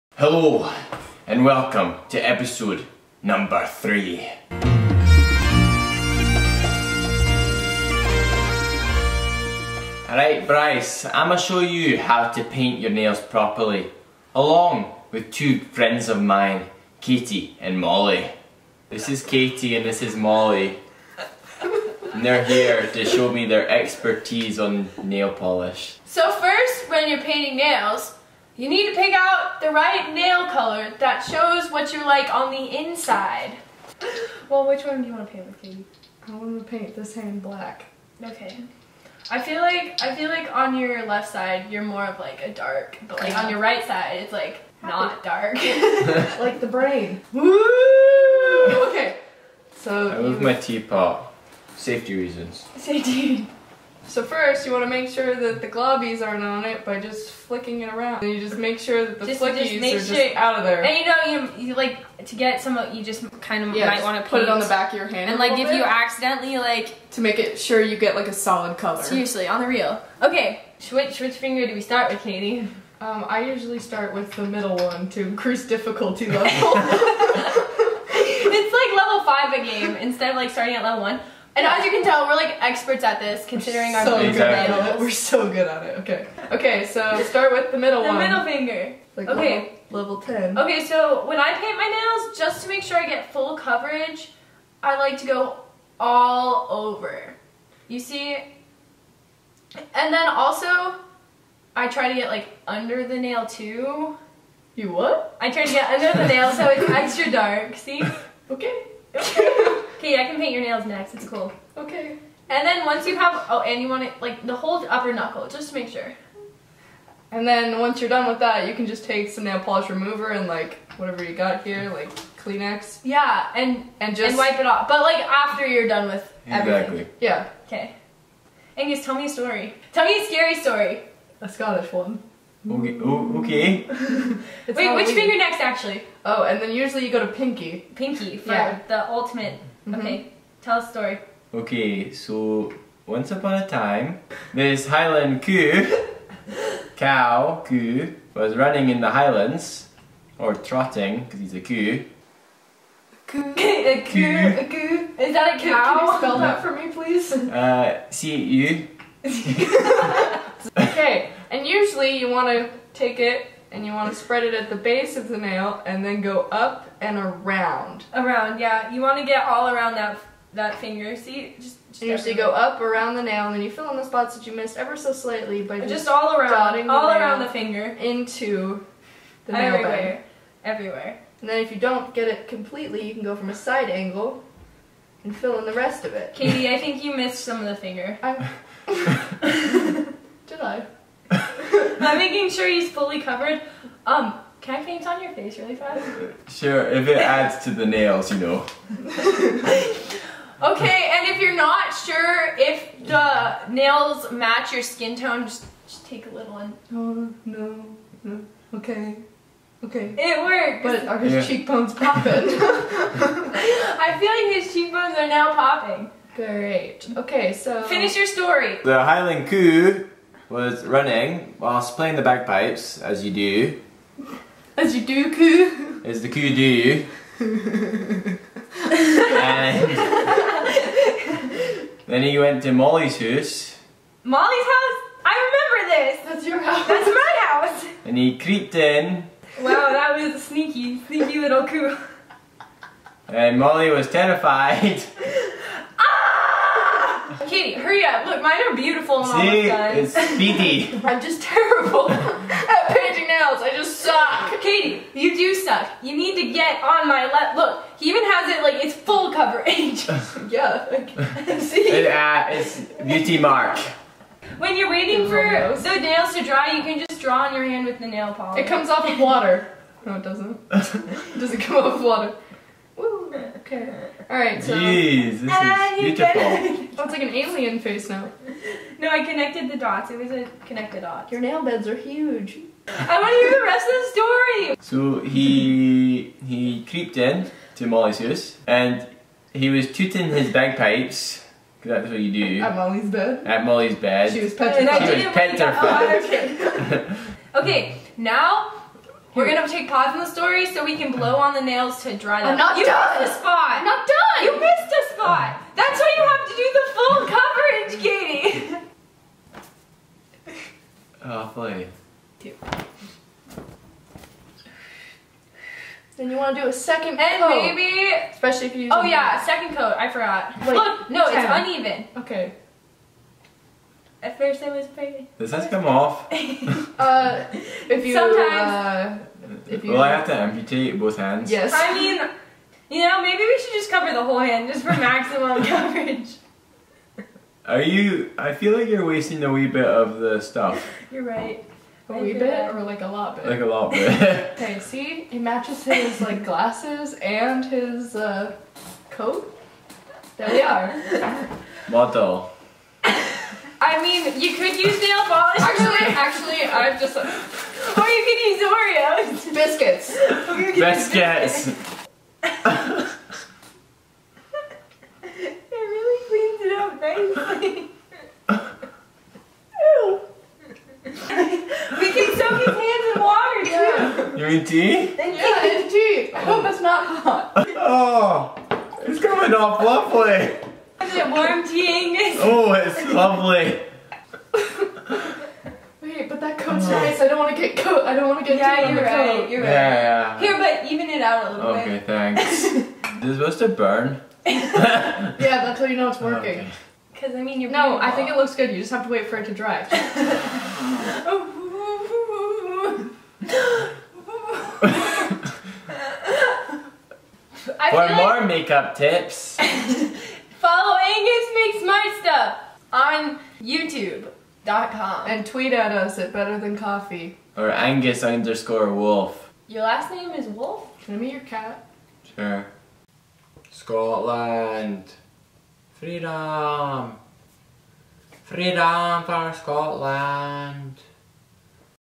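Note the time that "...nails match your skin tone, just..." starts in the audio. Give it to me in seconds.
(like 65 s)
203 s.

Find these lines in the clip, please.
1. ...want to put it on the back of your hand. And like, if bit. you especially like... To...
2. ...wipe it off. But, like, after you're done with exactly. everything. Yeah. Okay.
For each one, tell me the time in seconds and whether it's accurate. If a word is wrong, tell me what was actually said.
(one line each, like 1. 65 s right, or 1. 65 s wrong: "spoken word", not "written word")
1. 64 s wrong: "accidentally", not "especially"
2. 124 s right.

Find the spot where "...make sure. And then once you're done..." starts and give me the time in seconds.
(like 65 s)
115 s.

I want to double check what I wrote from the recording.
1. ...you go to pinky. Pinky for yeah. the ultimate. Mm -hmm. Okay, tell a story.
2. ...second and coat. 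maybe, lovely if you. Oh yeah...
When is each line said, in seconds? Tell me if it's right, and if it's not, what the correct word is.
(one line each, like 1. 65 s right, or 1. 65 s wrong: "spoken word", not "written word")
1. 137 s right
2. 316 s wrong: "especially", not "lovely".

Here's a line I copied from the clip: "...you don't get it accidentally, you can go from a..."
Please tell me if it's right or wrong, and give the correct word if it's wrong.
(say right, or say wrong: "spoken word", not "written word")
wrong: "completely", not "accidentally".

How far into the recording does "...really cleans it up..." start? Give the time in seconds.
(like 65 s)
365 s.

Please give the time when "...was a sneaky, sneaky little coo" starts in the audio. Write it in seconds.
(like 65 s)
240 s.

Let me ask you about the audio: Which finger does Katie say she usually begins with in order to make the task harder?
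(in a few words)
Middle finger.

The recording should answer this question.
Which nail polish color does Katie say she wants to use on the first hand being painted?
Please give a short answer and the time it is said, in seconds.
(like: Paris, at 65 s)
Black, at 37 s.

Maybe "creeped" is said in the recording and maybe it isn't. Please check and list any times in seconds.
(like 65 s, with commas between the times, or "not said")
238 s, 286 s.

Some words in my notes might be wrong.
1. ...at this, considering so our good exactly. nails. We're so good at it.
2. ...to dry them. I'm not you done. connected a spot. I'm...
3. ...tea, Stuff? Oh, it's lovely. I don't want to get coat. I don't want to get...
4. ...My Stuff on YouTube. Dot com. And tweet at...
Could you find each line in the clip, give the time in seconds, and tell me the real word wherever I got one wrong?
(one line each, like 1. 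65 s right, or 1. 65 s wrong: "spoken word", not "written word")
1. 83 s right
2. 302 s wrong: "missed", not "connected"
3. 381 s wrong: "Angus", not "Stuff"
4. 411 s right.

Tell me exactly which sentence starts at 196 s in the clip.
Sure, if it adds to the nails, you know.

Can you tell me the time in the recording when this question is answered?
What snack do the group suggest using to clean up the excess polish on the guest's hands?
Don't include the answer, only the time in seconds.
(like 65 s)
359 s.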